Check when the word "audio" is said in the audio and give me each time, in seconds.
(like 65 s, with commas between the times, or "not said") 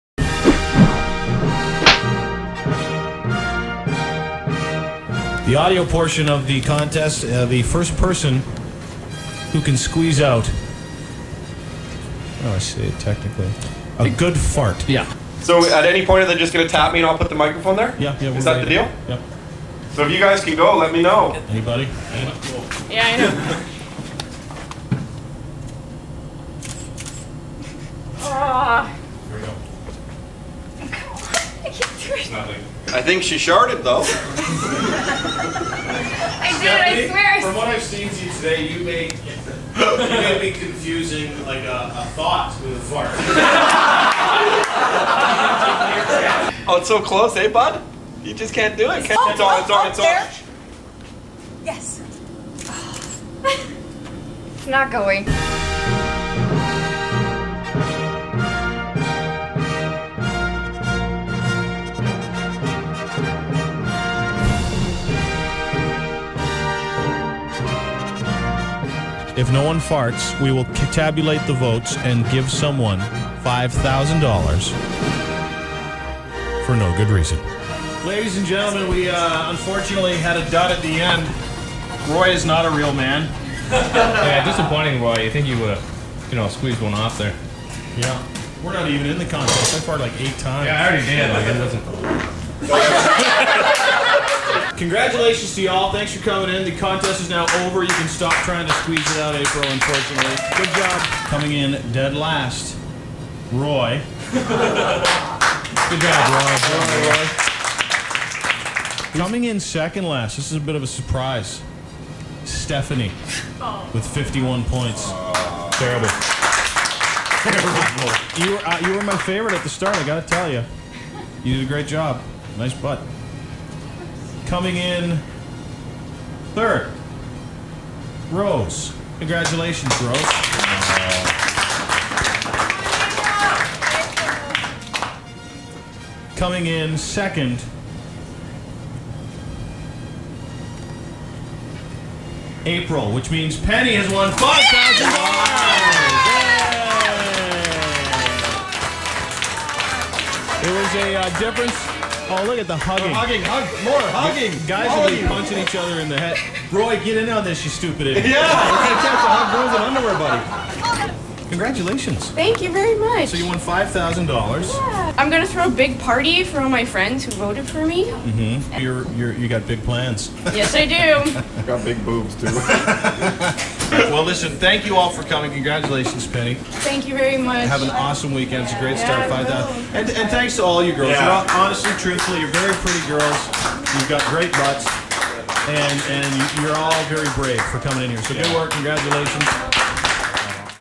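5 s.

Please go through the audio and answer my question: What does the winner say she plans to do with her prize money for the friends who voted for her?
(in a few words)
Throw a big party.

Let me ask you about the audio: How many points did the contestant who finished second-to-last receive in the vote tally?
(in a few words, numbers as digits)
51.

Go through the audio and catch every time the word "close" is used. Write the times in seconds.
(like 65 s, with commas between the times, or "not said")
46 s.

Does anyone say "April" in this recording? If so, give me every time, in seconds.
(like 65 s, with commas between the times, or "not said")
99 s, 142 s.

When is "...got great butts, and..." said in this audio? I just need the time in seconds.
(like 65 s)
184 s.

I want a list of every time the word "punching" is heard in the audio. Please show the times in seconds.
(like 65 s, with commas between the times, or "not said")
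155 s.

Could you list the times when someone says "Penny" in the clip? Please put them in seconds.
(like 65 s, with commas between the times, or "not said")
143 s, 176 s.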